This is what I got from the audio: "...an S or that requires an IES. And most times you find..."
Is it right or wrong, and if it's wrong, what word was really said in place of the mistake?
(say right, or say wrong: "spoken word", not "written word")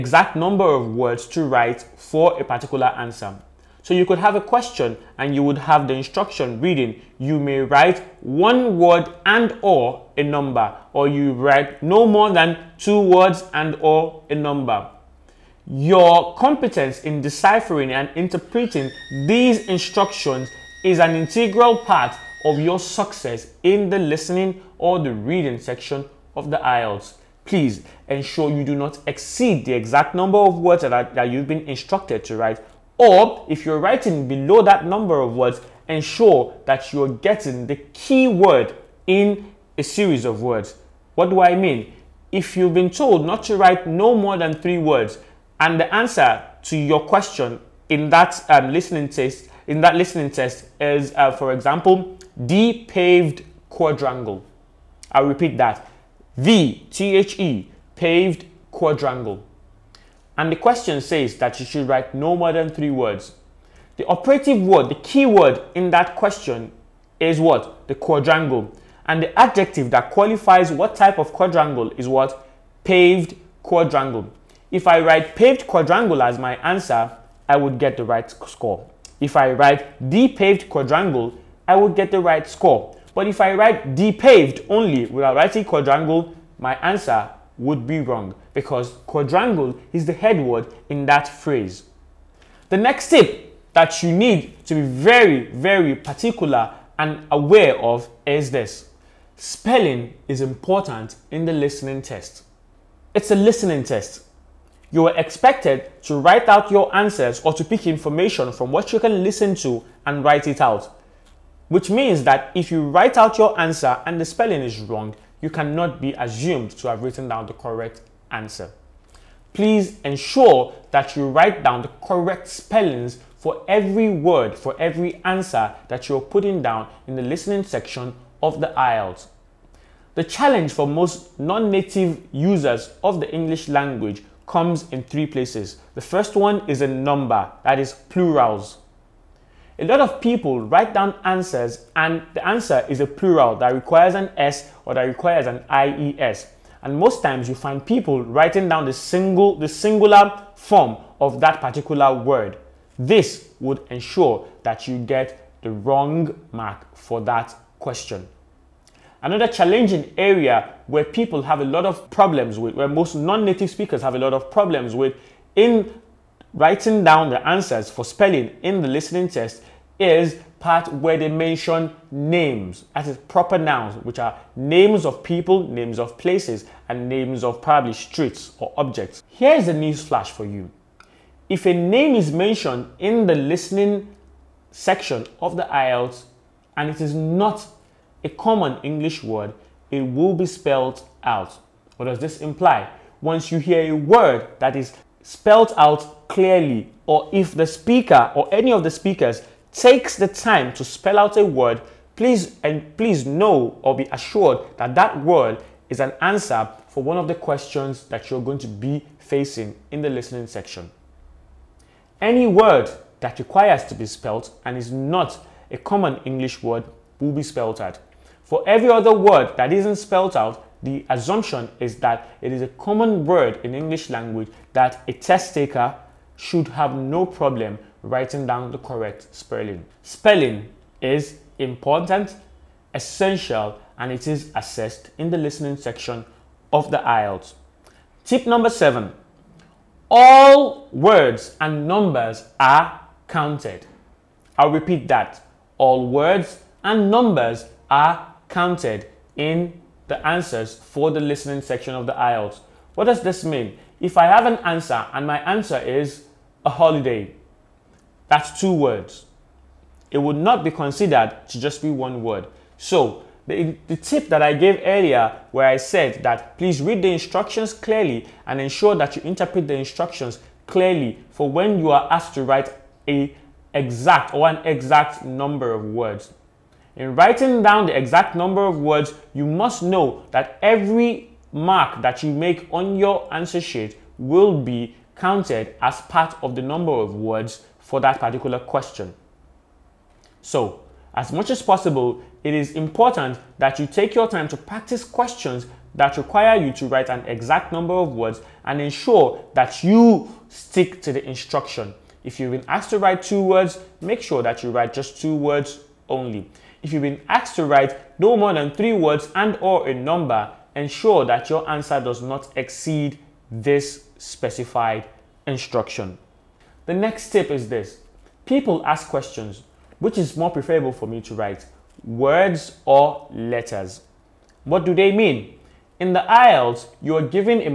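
right.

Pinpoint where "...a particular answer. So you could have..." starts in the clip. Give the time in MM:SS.
00:02.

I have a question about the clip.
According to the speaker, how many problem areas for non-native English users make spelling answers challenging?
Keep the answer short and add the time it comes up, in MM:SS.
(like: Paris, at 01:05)
3, at 02:14.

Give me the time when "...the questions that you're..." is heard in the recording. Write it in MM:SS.
03:27.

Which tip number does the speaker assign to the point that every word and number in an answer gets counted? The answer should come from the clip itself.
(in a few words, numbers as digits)
7.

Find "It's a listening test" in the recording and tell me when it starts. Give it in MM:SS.
01:43.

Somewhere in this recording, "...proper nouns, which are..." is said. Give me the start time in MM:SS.
02:53.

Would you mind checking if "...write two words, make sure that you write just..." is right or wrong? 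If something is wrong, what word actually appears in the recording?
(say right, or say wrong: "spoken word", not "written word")
right.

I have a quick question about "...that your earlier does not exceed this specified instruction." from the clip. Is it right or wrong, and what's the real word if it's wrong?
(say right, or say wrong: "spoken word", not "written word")
wrong: "answer", not "earlier".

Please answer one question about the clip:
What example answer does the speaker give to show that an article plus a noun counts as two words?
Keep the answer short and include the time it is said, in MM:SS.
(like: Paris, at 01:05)
a holiday, at 04:16.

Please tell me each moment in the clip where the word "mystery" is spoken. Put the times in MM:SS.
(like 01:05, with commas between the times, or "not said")
not said.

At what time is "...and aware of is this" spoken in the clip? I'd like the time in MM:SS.
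01:36.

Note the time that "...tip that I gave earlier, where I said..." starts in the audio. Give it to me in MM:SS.
04:23.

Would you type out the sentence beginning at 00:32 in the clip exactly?
Or if you're writing below that number of words, ensure that you're getting the key word in a series of words.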